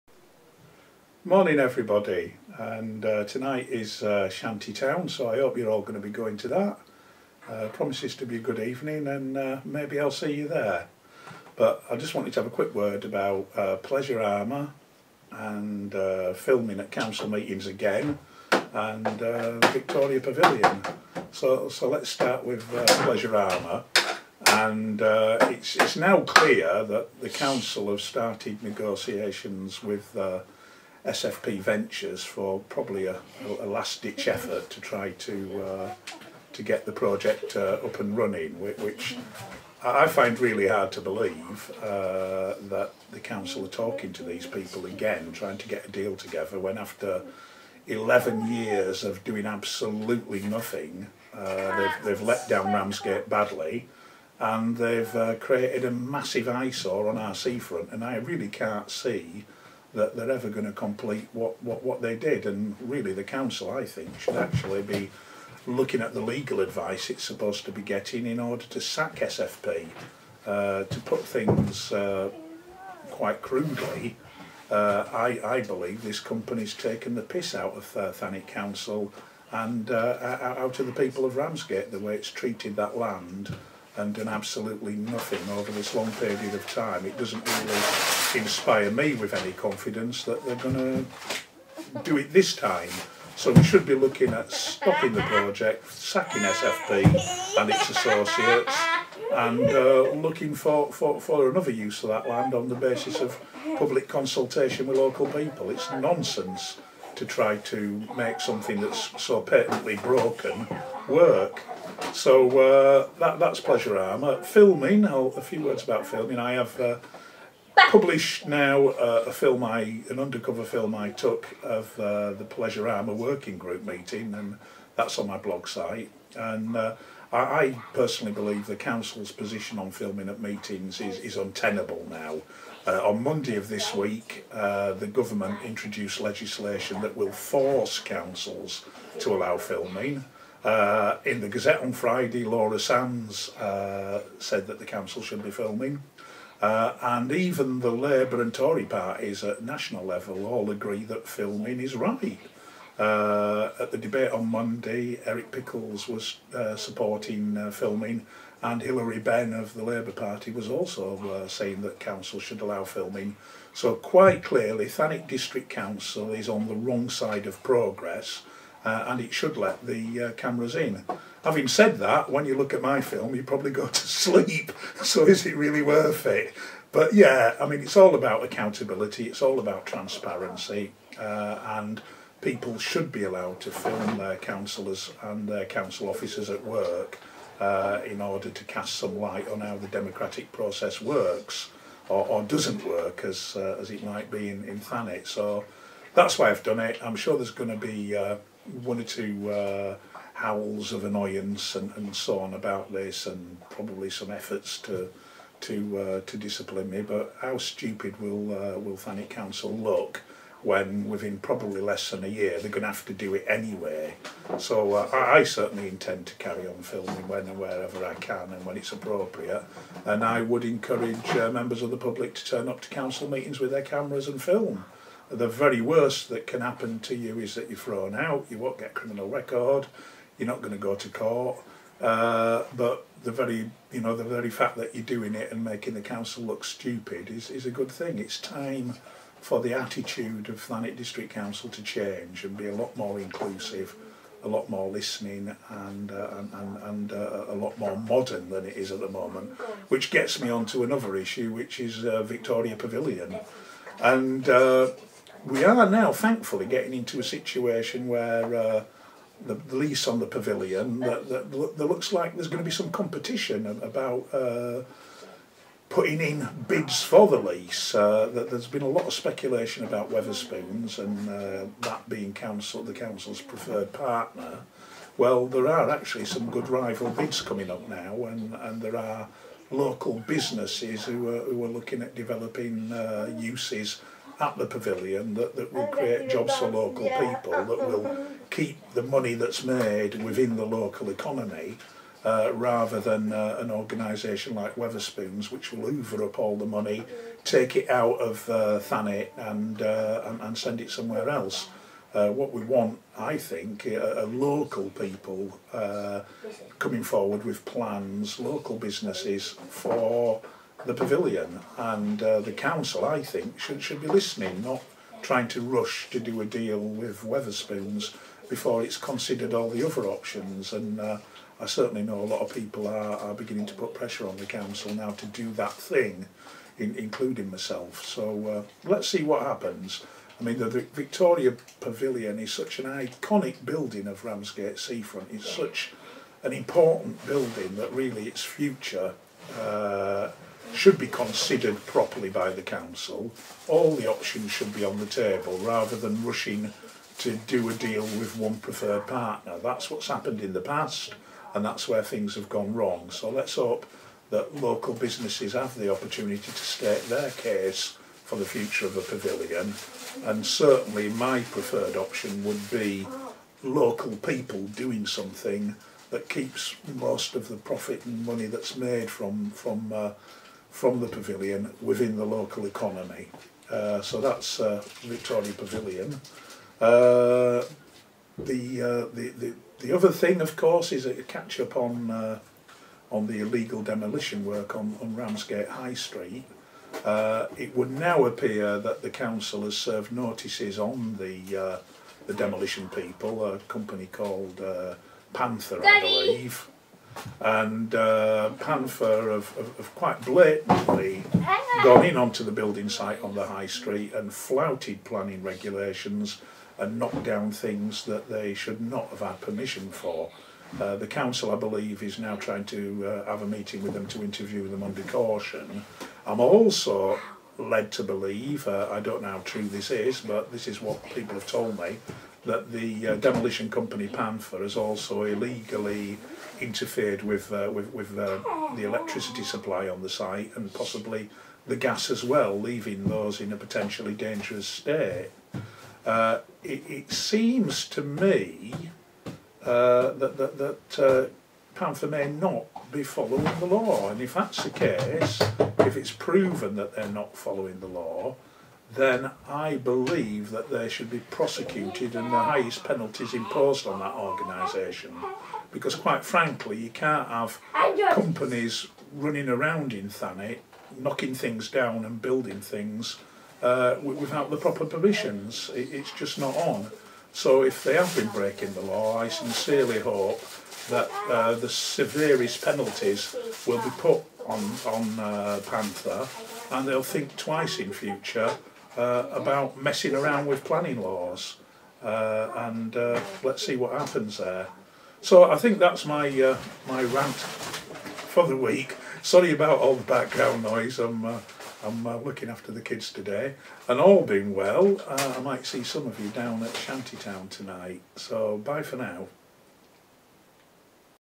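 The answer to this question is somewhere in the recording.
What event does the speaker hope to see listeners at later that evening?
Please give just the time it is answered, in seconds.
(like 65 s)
496 s.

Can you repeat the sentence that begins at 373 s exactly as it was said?
Uh, so that's uh, Victoria Pavilion.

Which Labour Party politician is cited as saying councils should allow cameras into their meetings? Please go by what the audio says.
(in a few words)
Hilary Benn.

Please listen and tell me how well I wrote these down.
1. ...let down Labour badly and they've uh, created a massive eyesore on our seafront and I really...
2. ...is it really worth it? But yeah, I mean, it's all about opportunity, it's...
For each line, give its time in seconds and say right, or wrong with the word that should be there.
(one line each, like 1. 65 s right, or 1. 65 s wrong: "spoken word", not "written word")
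1. 52 s wrong: "Ramsgate", not "Labour"
2. 175 s wrong: "accountability", not "opportunity".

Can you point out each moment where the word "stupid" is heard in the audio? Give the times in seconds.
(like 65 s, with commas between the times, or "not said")
207 s, 236 s.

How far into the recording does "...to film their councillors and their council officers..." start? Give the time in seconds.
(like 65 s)
183 s.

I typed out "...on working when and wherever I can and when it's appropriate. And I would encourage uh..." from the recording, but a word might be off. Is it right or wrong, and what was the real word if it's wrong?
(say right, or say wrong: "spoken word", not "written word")
wrong: "filming", not "working".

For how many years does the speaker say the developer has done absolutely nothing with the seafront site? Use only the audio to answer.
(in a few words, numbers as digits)
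11.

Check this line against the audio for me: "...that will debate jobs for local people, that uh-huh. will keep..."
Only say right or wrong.
wrong.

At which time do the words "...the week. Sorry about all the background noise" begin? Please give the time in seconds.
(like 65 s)
488 s.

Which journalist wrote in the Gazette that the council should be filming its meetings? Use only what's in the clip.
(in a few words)
Laura Sands.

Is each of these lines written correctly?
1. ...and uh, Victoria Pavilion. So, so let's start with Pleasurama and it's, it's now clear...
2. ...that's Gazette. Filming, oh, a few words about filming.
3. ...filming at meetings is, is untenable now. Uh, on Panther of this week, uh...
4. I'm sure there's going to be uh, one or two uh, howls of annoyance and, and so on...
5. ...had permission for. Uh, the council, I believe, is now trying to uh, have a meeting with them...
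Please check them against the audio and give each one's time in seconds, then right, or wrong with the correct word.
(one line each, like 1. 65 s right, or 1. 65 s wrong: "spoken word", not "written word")
1. 18 s right
2. 113 s wrong: "Pleasurama", not "Gazette"
3. 129 s wrong: "Monday", not "Panther"
4. 197 s right
5. 409 s right.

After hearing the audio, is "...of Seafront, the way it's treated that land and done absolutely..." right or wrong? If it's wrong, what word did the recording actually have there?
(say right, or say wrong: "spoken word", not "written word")
wrong: "Ramsgate", not "Seafront".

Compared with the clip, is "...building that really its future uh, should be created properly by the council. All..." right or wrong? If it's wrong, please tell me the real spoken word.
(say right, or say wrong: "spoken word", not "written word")
wrong: "considered", not "created".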